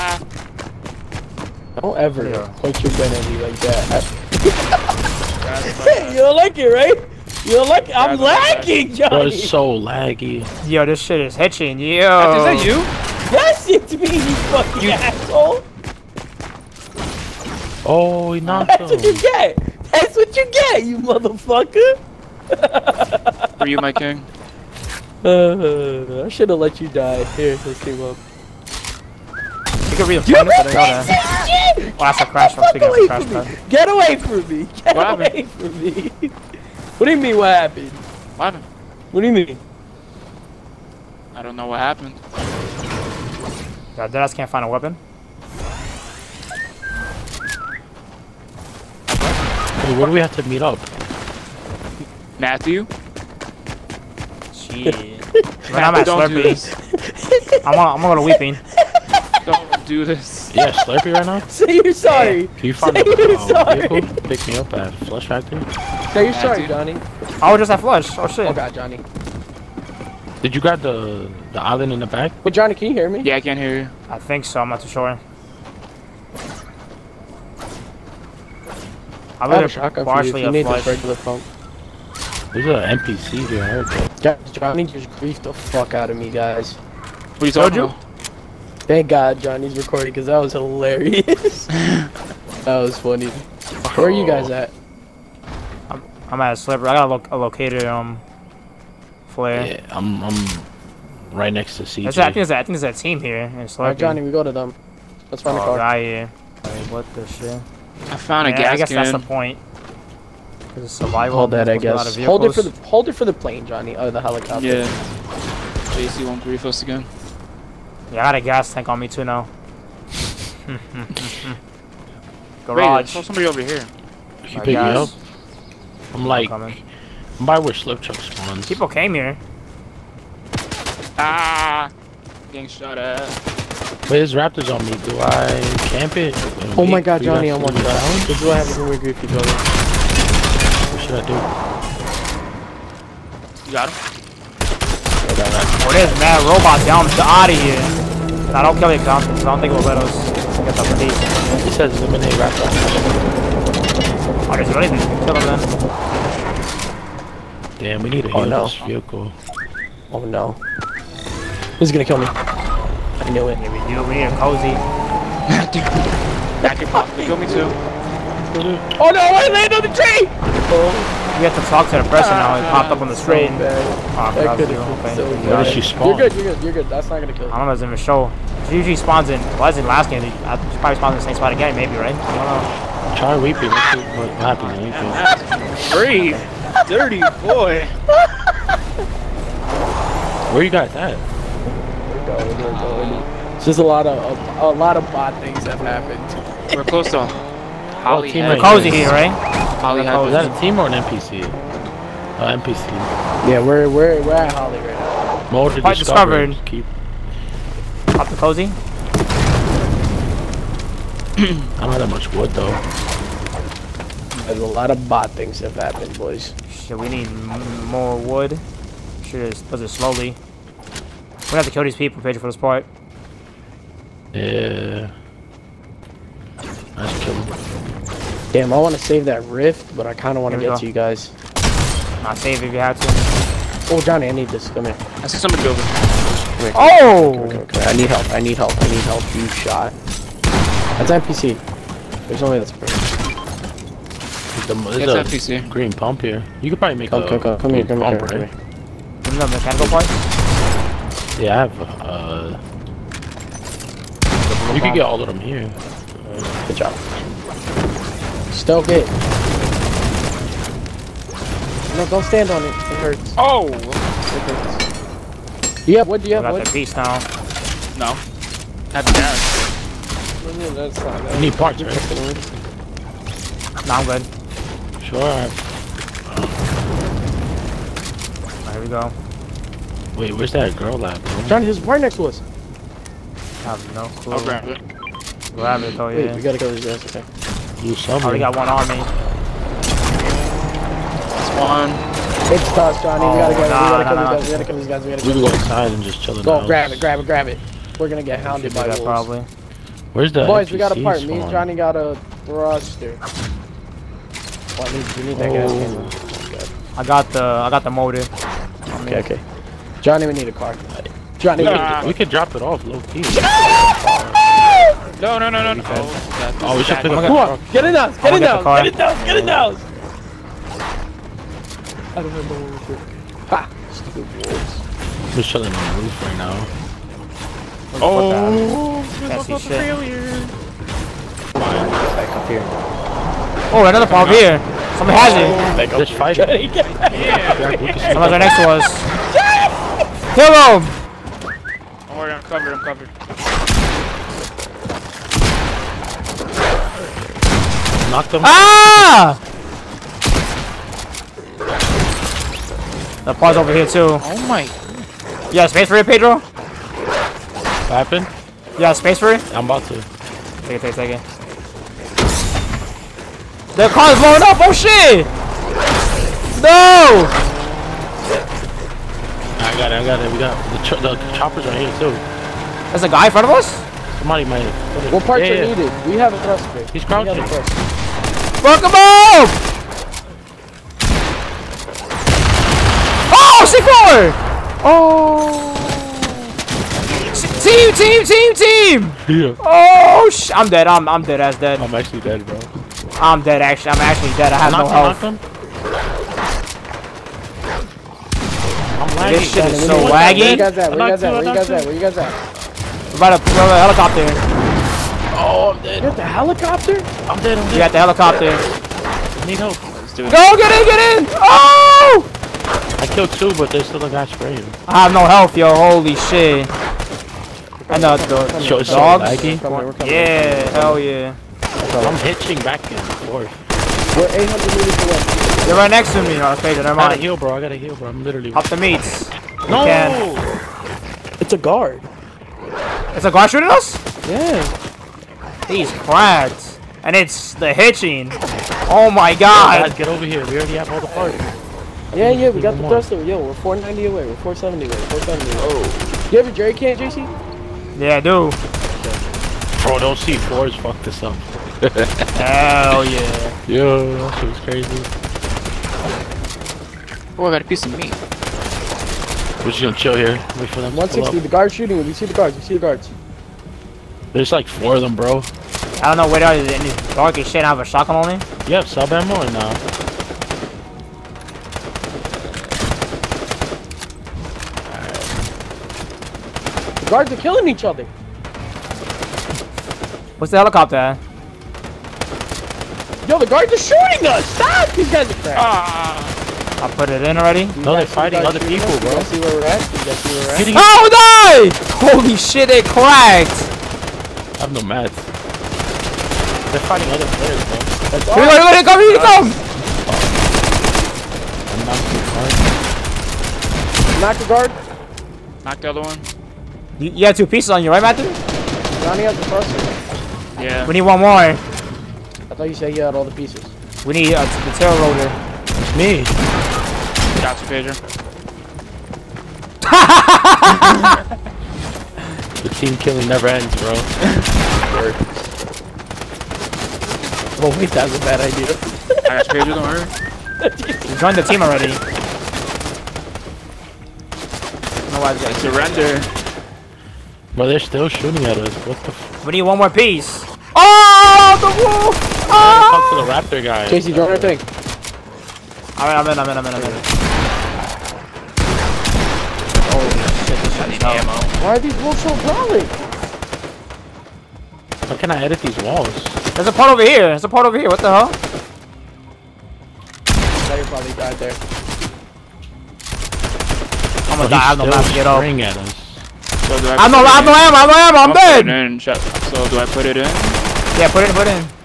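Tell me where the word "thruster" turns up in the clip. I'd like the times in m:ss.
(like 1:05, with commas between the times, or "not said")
5:02, 7:22.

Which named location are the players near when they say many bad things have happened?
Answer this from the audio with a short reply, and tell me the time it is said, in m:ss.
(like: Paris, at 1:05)
Holly Hype, at 3:19.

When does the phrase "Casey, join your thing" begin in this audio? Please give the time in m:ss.
9:03.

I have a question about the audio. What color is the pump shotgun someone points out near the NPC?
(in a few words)
green.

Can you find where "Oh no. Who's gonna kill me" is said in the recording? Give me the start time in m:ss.
2:40.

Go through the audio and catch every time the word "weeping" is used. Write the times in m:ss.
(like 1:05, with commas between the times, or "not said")
0:58, 3:03.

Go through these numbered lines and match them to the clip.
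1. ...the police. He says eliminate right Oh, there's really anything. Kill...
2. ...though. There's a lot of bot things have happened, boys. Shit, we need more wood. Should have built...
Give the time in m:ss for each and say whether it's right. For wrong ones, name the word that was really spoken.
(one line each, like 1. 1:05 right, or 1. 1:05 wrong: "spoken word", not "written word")
1. 2:30 right
2. 3:32 right.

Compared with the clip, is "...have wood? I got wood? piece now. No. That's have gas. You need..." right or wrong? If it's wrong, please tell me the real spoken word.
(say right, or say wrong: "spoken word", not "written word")
right.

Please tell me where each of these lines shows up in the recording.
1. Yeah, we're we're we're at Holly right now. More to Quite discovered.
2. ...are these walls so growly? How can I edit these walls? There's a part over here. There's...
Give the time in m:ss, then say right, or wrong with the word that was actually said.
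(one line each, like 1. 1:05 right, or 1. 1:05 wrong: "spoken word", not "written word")
1. 3:23 right
2. 9:11 right.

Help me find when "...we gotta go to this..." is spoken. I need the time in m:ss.
4:46.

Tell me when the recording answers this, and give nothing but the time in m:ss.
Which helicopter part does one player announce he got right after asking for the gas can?
5:07.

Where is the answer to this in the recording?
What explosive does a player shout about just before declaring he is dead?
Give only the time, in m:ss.
6:23.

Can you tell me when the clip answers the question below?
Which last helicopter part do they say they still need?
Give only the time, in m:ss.
8:34.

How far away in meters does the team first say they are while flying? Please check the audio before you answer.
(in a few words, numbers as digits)
800 meters.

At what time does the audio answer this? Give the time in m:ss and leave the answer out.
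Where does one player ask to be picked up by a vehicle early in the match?
1:05.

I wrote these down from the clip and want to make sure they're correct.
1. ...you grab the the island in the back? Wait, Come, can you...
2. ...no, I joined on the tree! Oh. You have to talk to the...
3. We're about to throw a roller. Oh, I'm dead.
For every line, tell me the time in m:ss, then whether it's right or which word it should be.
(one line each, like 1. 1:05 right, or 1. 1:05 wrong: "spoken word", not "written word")
1. 1:10 wrong: "Johnny", not "Come"
2. 2:49 wrong: "landed", not "joined"
3. 6:43 wrong: "helicopter", not "roller".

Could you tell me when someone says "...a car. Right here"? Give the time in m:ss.
1:45.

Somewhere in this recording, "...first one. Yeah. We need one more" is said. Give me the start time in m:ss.
8:29.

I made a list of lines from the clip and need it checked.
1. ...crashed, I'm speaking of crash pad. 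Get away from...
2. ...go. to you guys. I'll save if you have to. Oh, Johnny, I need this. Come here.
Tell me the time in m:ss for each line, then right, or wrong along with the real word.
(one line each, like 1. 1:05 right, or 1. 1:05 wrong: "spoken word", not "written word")
1. 0:32 right
2. 3:50 right.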